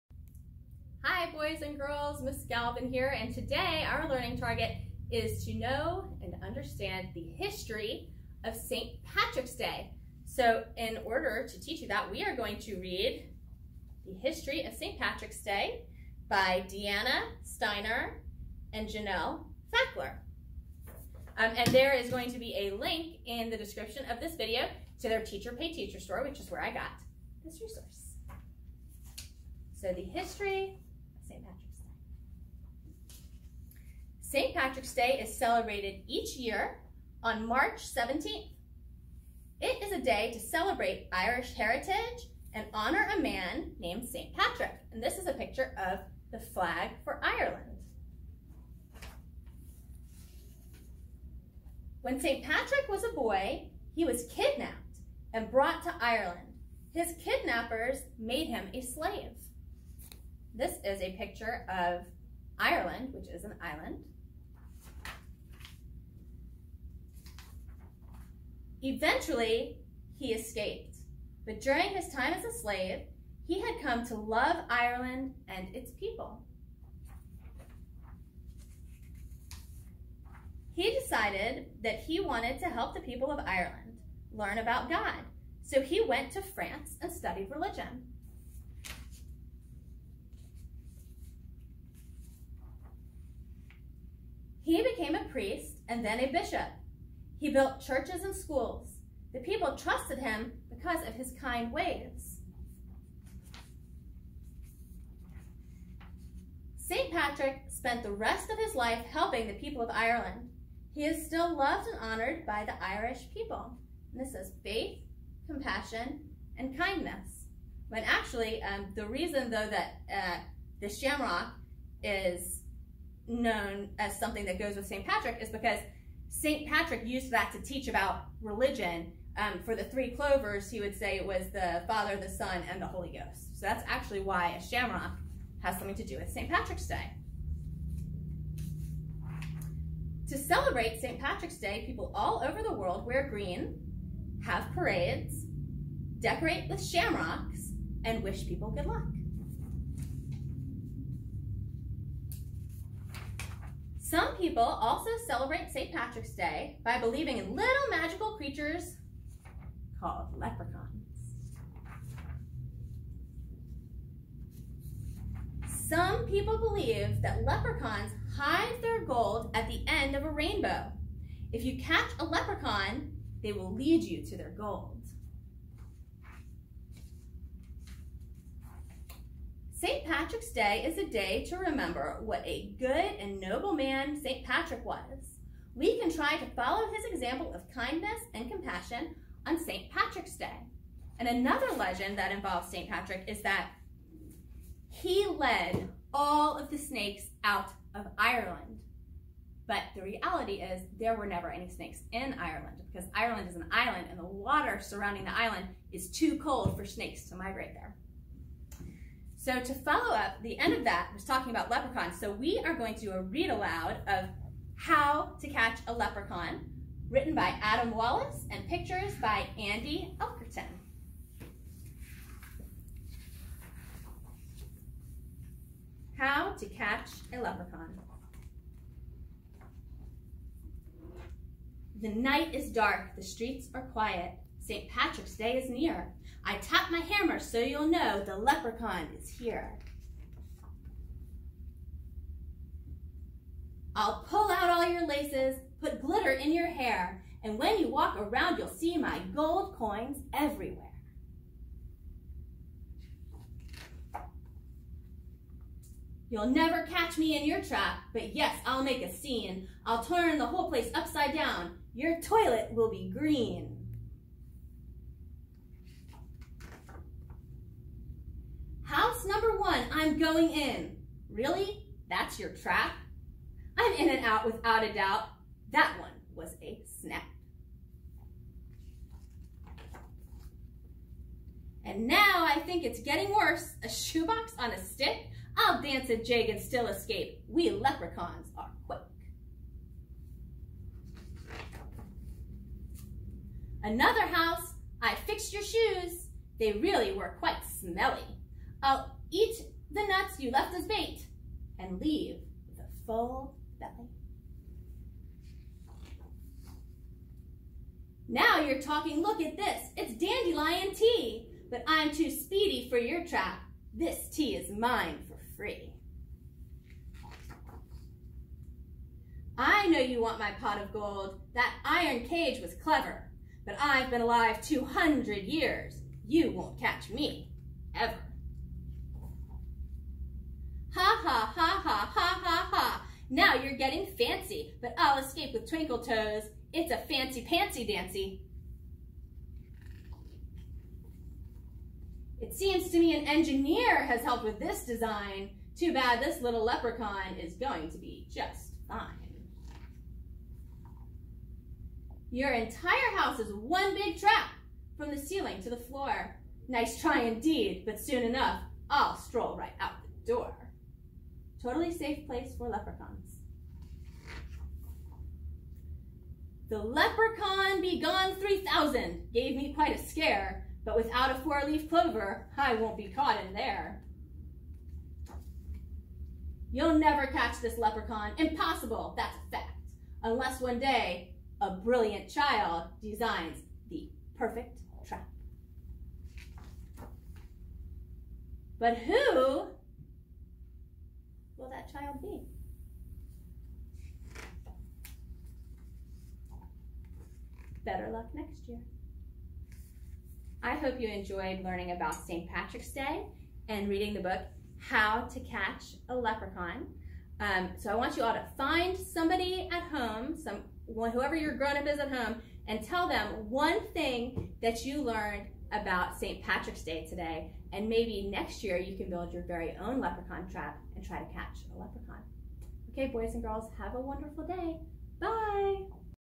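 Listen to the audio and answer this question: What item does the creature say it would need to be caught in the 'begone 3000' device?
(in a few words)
A four-leaf clover.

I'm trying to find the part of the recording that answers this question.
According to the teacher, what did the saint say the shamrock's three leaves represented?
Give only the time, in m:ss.
2:11.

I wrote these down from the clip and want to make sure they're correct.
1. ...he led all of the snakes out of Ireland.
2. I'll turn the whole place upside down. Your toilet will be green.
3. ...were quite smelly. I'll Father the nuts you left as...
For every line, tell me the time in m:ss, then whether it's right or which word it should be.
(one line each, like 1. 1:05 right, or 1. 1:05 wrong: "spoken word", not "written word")
1. 3:14 right
2. 4:19 right
3. 4:57 wrong: "Eat", not "Father".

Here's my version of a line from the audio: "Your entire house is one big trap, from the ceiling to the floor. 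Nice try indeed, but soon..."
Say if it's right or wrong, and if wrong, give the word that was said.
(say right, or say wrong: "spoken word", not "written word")
right.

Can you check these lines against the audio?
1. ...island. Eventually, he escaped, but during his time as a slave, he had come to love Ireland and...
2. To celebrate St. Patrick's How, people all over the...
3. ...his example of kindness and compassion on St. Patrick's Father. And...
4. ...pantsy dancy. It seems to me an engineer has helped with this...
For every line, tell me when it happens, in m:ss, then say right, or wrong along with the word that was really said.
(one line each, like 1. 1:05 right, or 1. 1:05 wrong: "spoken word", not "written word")
1. 1:03 right
2. 2:20 wrong: "Day", not "How"
3. 3:06 wrong: "Day", not "Father"
4. 5:37 right.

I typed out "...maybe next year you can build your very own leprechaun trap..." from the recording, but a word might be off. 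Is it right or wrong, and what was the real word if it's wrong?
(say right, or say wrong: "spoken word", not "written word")
right.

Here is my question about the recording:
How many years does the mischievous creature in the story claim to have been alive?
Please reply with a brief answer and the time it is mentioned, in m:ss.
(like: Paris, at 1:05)
200, at 5:24.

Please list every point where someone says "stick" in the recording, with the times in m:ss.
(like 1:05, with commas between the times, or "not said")
4:44.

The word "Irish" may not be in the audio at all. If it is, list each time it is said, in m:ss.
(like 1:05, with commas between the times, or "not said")
0:41, 1:52.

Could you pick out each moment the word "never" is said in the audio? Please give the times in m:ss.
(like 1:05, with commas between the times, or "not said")
3:21, 4:16, 6:16.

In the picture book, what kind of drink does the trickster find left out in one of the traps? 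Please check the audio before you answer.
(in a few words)
Dandelion tea.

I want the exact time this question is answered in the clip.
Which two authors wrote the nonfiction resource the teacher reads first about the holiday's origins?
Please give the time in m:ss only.
0:16.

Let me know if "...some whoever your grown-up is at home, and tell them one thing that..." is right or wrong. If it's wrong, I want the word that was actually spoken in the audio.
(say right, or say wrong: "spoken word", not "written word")
right.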